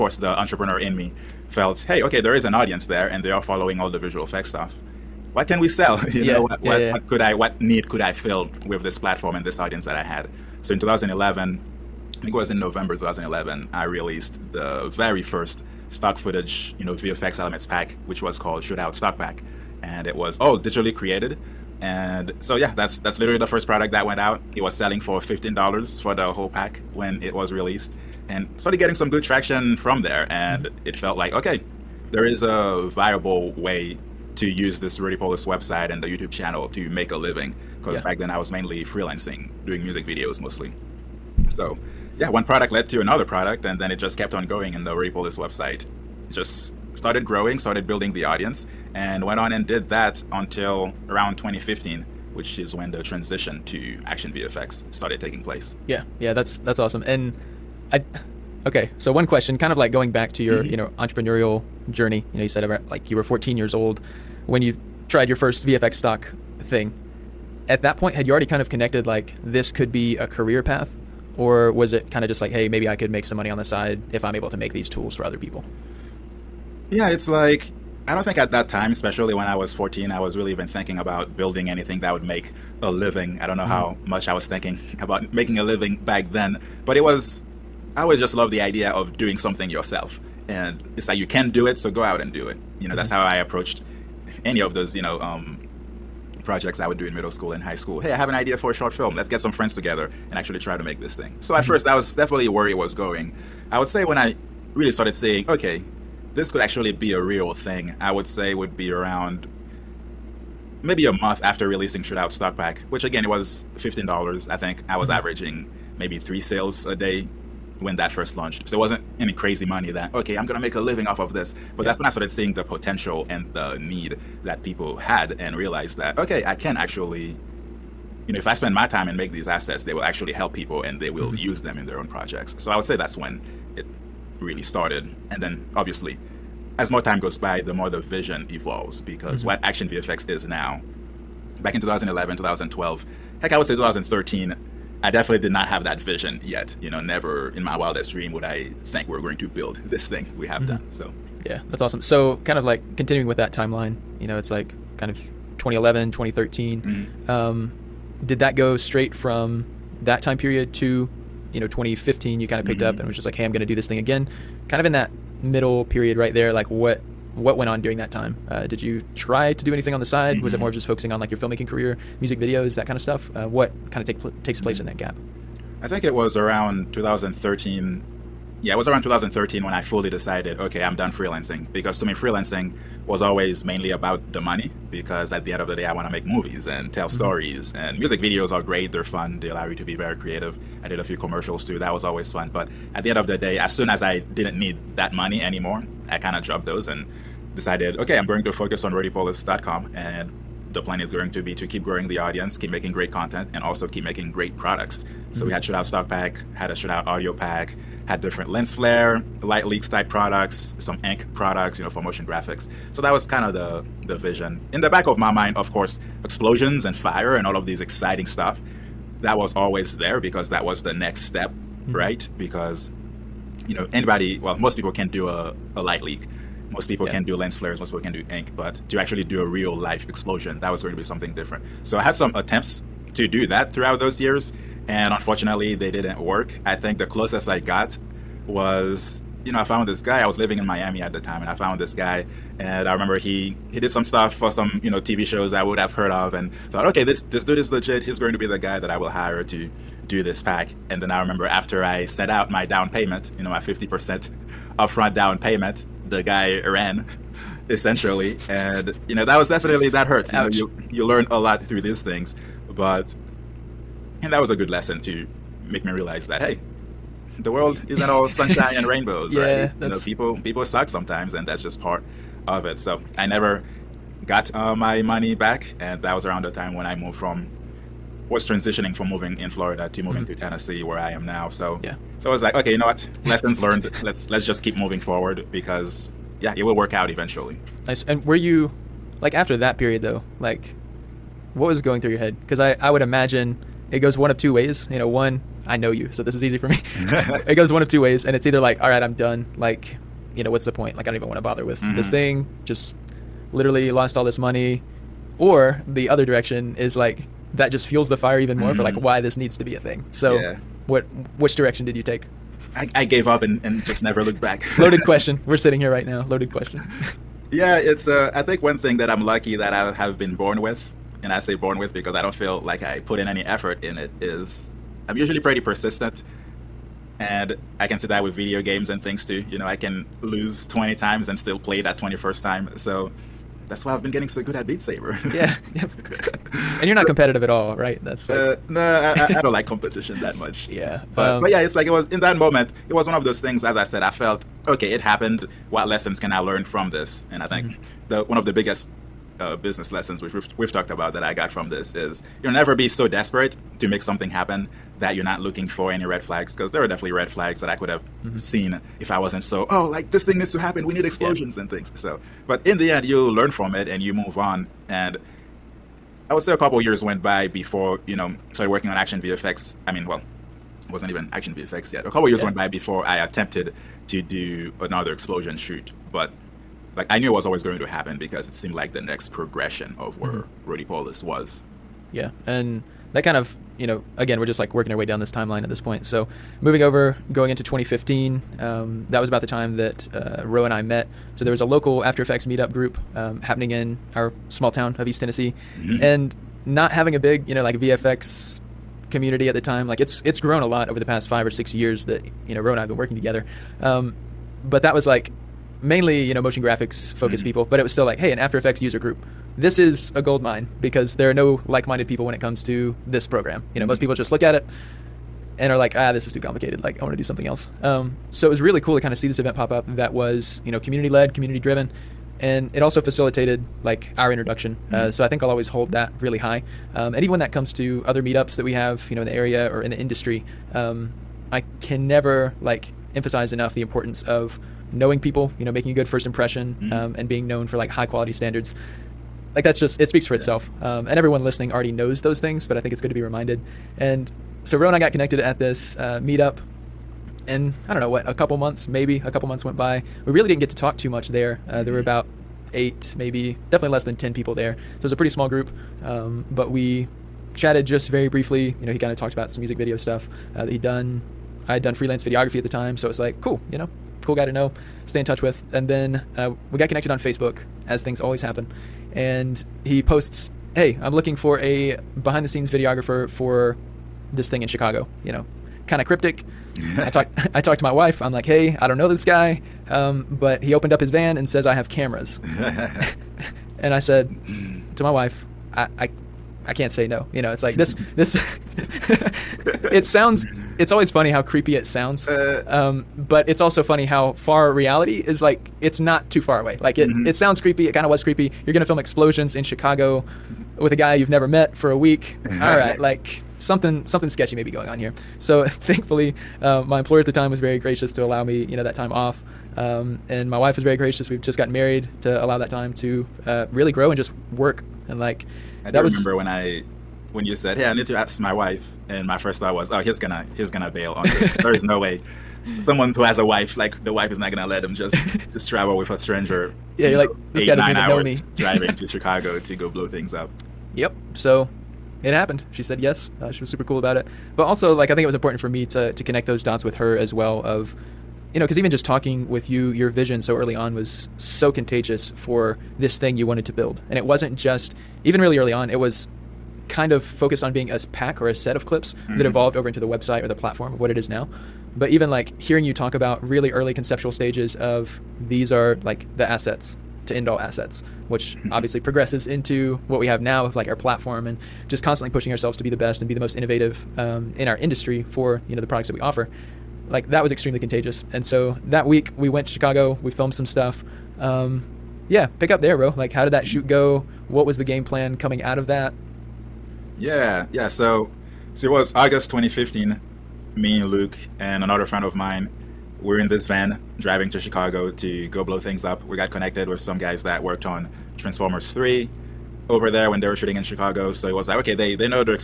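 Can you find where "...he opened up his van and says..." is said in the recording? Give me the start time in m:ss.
8:00.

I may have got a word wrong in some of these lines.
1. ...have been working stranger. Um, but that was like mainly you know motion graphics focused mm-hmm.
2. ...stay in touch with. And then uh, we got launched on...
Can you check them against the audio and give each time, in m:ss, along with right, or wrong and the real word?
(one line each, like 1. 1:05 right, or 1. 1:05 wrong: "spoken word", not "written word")
1. 6:42 wrong: "together", not "stranger"
2. 7:45 wrong: "connected", not "launched".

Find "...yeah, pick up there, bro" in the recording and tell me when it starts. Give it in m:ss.
9:32.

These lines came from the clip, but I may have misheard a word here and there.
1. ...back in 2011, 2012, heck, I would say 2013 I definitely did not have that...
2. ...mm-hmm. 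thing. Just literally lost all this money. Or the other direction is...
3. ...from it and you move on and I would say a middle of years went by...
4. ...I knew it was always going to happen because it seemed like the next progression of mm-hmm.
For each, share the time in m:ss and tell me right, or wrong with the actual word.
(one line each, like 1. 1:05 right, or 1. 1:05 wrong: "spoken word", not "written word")
1. 2:21 right
2. 5:02 right
3. 6:03 wrong: "couple", not "middle"
4. 6:17 right.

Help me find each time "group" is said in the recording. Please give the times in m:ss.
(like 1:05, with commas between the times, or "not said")
6:32, 6:48, 7:35.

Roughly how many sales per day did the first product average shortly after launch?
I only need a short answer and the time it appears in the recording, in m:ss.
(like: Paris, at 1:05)
3, at 1:56.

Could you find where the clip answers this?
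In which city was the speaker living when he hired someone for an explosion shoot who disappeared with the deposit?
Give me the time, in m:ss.
4:00.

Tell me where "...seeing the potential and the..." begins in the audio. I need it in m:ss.
2:02.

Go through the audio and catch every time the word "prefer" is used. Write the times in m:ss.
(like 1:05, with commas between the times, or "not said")
not said.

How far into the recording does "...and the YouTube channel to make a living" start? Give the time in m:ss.
0:35.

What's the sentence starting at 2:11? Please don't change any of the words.
use them in their own projects.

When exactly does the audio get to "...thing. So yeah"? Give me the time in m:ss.
5:09.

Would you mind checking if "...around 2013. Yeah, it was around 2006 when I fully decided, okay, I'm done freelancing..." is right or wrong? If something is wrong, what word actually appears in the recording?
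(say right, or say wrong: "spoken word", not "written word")
wrong: "2013", not "2006".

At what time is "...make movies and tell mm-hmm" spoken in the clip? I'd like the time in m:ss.
3:06.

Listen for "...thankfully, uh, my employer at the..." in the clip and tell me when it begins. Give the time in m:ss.
8:25.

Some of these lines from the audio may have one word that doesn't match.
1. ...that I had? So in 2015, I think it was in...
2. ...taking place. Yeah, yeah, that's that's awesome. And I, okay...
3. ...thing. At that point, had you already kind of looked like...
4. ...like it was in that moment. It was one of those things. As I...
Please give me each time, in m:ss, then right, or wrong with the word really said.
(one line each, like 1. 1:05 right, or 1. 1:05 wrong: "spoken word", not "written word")
1. 0:09 wrong: "2011", not "2015"
2. 0:55 right
3. 1:06 wrong: "connected", not "looked"
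4. 5:41 right.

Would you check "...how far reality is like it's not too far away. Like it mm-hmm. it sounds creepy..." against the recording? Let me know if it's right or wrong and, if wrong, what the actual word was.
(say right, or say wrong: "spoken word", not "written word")
right.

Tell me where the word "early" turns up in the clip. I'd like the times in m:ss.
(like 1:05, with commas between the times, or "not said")
9:00, 9:05, 9:13.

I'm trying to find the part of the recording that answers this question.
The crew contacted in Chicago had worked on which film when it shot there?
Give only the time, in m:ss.
9:48.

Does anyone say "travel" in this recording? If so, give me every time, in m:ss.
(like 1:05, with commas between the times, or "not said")
8:45.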